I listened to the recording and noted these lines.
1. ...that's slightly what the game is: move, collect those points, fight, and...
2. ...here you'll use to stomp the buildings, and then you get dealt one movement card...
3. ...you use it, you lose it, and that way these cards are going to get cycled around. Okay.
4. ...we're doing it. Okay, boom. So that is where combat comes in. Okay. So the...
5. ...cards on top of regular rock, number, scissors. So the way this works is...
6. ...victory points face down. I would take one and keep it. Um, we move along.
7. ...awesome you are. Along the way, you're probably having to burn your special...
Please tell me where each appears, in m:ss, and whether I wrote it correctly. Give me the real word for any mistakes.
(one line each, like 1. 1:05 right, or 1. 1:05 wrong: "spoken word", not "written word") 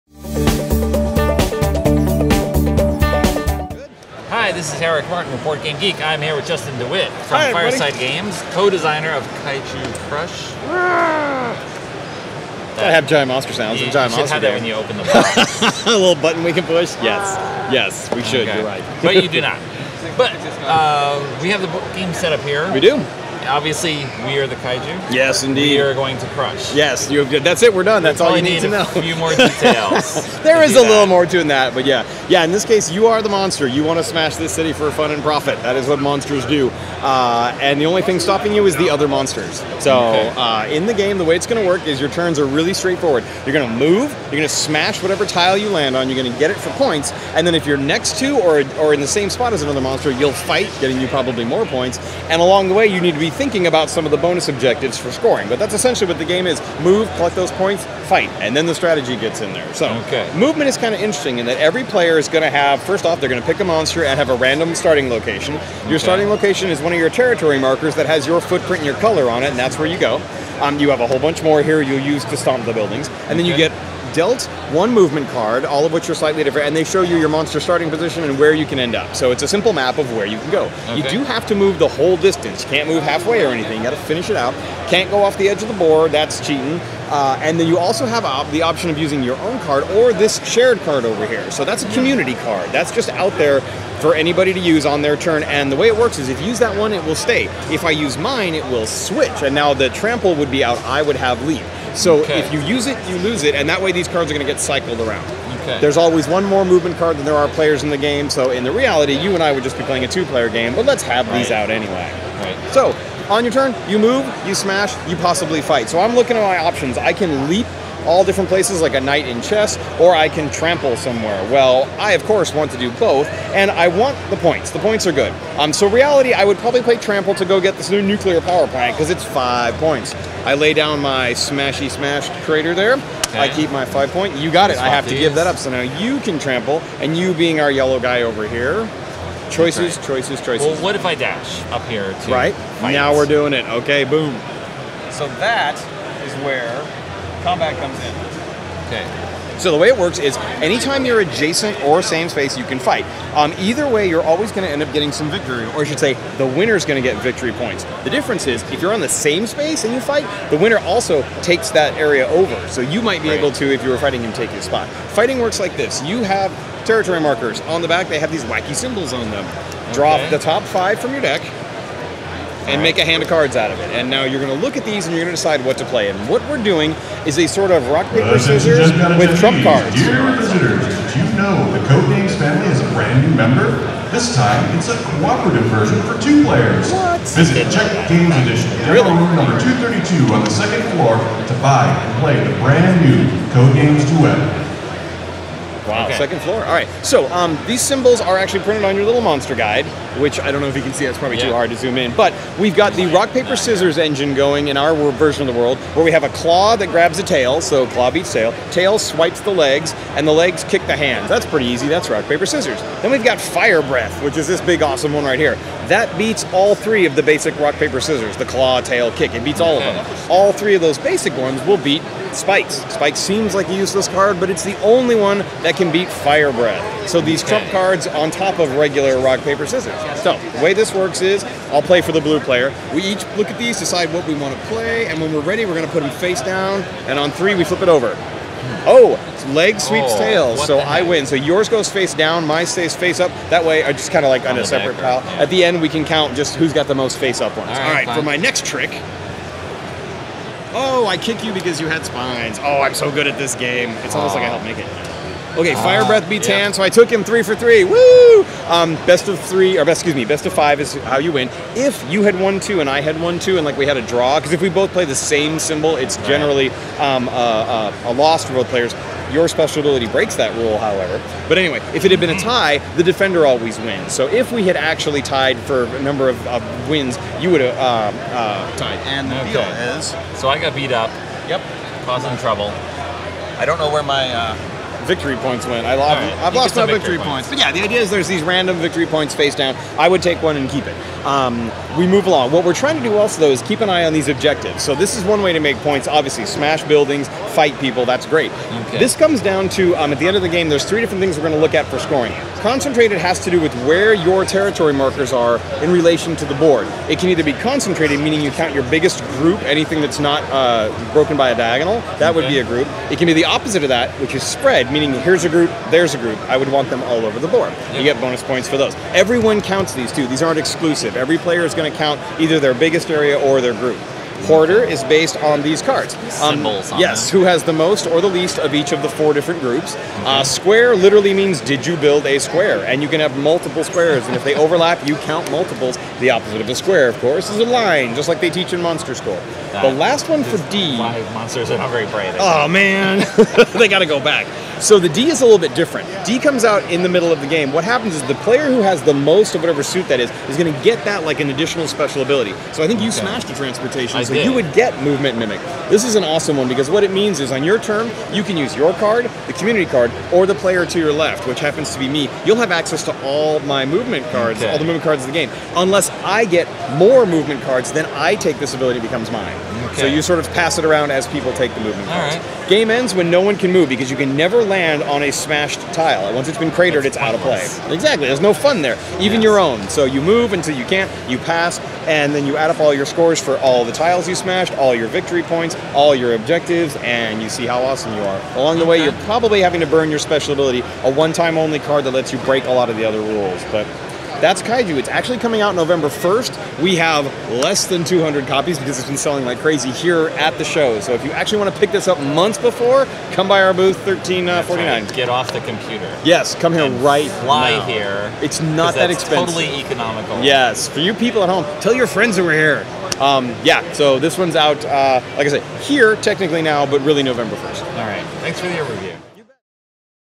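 1. 0:55 wrong: "essentially", not "slightly"
2. 1:11 right
3. 1:42 right
4. 2:23 right
5. 3:47 wrong: "paper", not "number"
6. 4:48 right
7. 6:27 right.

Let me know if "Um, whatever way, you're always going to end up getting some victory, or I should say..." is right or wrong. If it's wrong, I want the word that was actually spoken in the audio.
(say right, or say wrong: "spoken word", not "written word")
wrong: "either", not "whatever".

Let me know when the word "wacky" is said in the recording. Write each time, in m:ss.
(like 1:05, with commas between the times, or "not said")
2:48.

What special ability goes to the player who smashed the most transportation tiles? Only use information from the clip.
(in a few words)
Movement Mimic.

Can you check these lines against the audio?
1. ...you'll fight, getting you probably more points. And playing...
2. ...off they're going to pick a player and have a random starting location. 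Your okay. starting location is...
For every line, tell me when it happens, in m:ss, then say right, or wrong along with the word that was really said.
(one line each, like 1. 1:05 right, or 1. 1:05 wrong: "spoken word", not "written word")
1. 0:50 wrong: "along", not "playing"
2. 1:03 wrong: "monster", not "player".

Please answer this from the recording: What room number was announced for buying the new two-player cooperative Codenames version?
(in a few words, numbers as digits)
232.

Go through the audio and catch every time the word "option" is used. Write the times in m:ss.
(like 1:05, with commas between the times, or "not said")
1:28, 1:56.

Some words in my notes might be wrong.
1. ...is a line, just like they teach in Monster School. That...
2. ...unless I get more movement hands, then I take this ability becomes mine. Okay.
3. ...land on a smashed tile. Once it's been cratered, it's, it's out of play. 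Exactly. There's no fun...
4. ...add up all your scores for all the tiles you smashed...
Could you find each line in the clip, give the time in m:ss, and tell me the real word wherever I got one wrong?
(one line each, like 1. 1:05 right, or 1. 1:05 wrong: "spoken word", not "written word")
1. 5:37 right
2. 6:05 wrong: "cards", not "hands"
3. 6:14 right
4. 6:22 right.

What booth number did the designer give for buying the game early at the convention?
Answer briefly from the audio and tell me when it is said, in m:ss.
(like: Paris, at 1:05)
1349, at 6:43.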